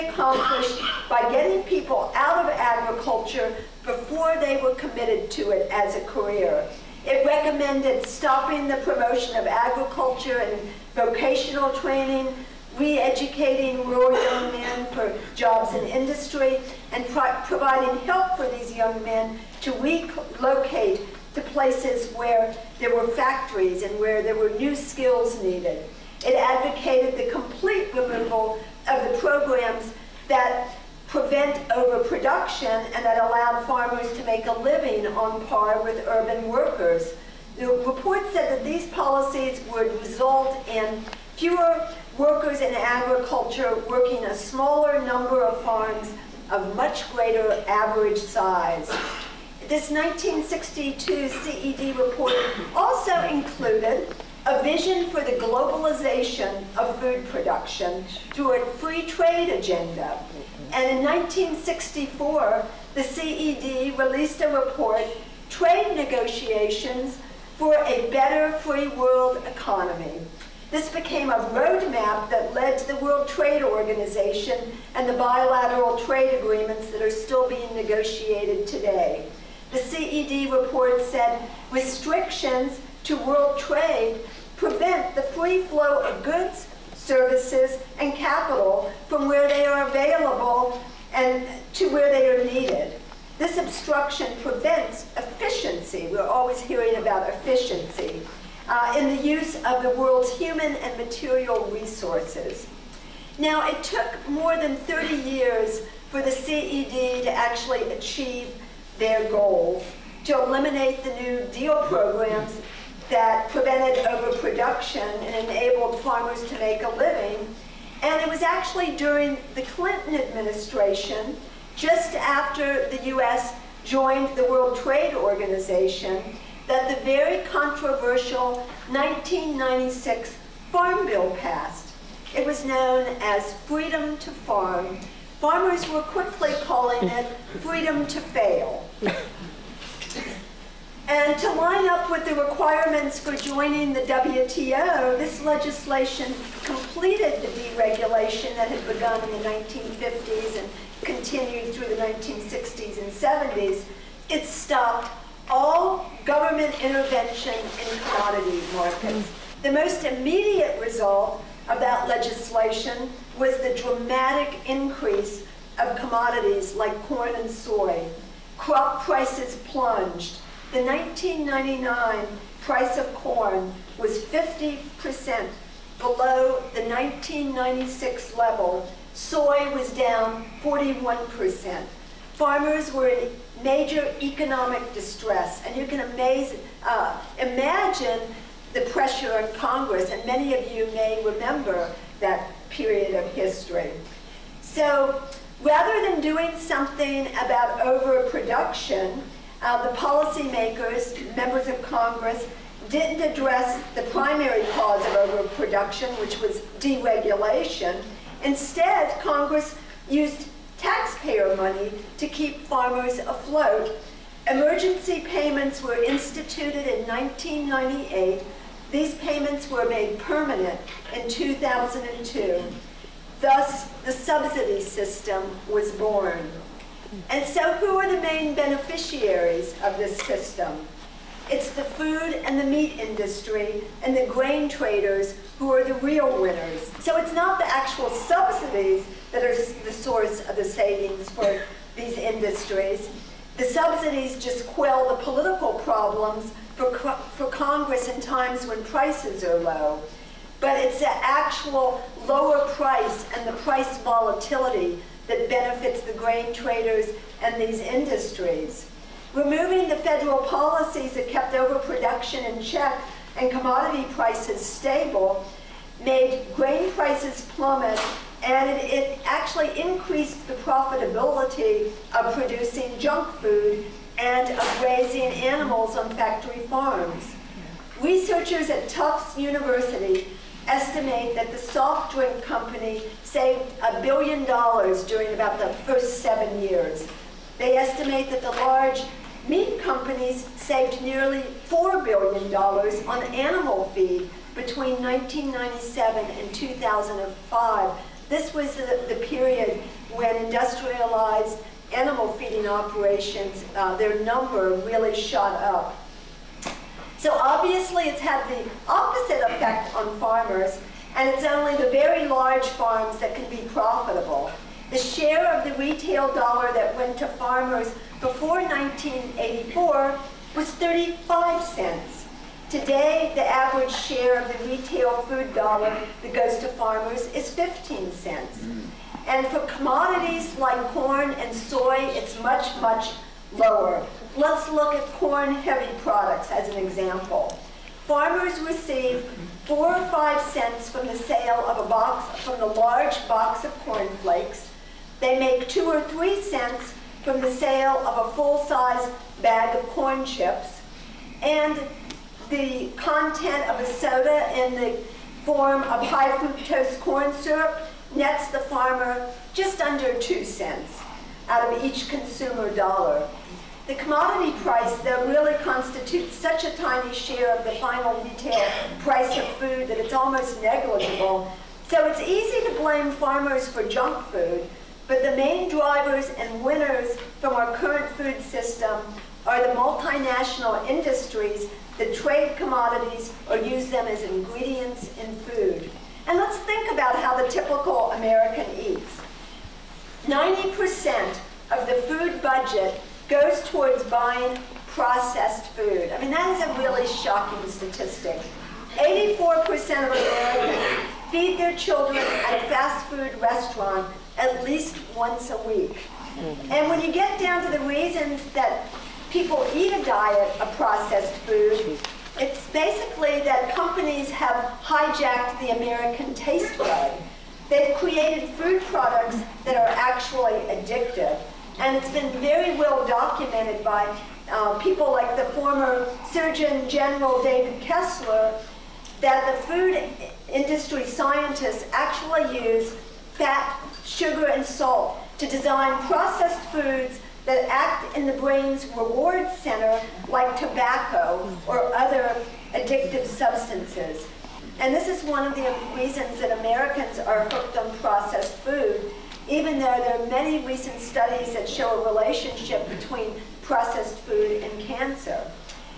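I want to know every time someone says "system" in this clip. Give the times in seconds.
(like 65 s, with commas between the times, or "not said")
224 s, 230 s, 378 s.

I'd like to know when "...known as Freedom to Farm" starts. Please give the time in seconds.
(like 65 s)
132 s.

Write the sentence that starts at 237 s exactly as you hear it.
So it's not the actual subsidies that are the source of the savings for these industries.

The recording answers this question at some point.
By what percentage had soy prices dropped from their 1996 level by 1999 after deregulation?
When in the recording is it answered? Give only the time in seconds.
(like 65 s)
180 s.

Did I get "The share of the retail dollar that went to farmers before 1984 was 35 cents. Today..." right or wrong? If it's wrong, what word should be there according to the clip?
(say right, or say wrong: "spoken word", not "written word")
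right.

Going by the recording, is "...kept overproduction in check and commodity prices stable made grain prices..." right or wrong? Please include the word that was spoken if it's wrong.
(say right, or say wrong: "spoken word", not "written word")
right.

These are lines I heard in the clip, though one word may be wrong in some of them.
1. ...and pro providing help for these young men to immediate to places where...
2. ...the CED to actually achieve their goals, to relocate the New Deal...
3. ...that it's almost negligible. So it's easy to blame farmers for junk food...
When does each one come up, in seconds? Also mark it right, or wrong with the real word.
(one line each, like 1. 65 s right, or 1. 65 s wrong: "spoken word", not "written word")
1. 16 s wrong: "relocate", not "immediate"
2. 106 s wrong: "eliminate", not "relocate"
3. 369 s right.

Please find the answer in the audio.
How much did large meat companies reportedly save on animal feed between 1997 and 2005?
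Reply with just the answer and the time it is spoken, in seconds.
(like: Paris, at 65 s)
nearly $4 billion, at 291 s.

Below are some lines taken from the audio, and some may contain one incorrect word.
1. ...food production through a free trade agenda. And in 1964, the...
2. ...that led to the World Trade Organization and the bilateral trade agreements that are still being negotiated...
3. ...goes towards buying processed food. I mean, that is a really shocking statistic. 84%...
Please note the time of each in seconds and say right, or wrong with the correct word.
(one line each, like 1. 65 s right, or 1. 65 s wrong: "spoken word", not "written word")
1. 56 s right
2. 72 s right
3. 393 s right.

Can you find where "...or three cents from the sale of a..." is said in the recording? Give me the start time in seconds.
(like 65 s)
345 s.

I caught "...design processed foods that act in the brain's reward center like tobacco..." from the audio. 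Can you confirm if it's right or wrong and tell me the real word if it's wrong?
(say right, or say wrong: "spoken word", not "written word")
right.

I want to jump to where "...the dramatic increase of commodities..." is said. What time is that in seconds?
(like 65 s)
163 s.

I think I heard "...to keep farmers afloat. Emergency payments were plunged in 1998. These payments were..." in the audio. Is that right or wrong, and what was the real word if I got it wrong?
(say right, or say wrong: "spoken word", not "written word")
wrong: "instituted", not "plunged".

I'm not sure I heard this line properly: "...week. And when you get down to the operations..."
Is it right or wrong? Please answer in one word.
wrong.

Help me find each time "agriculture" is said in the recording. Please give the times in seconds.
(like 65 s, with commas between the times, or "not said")
2 s, 9 s, 42 s.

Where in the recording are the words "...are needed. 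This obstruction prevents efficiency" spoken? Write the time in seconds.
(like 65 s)
92 s.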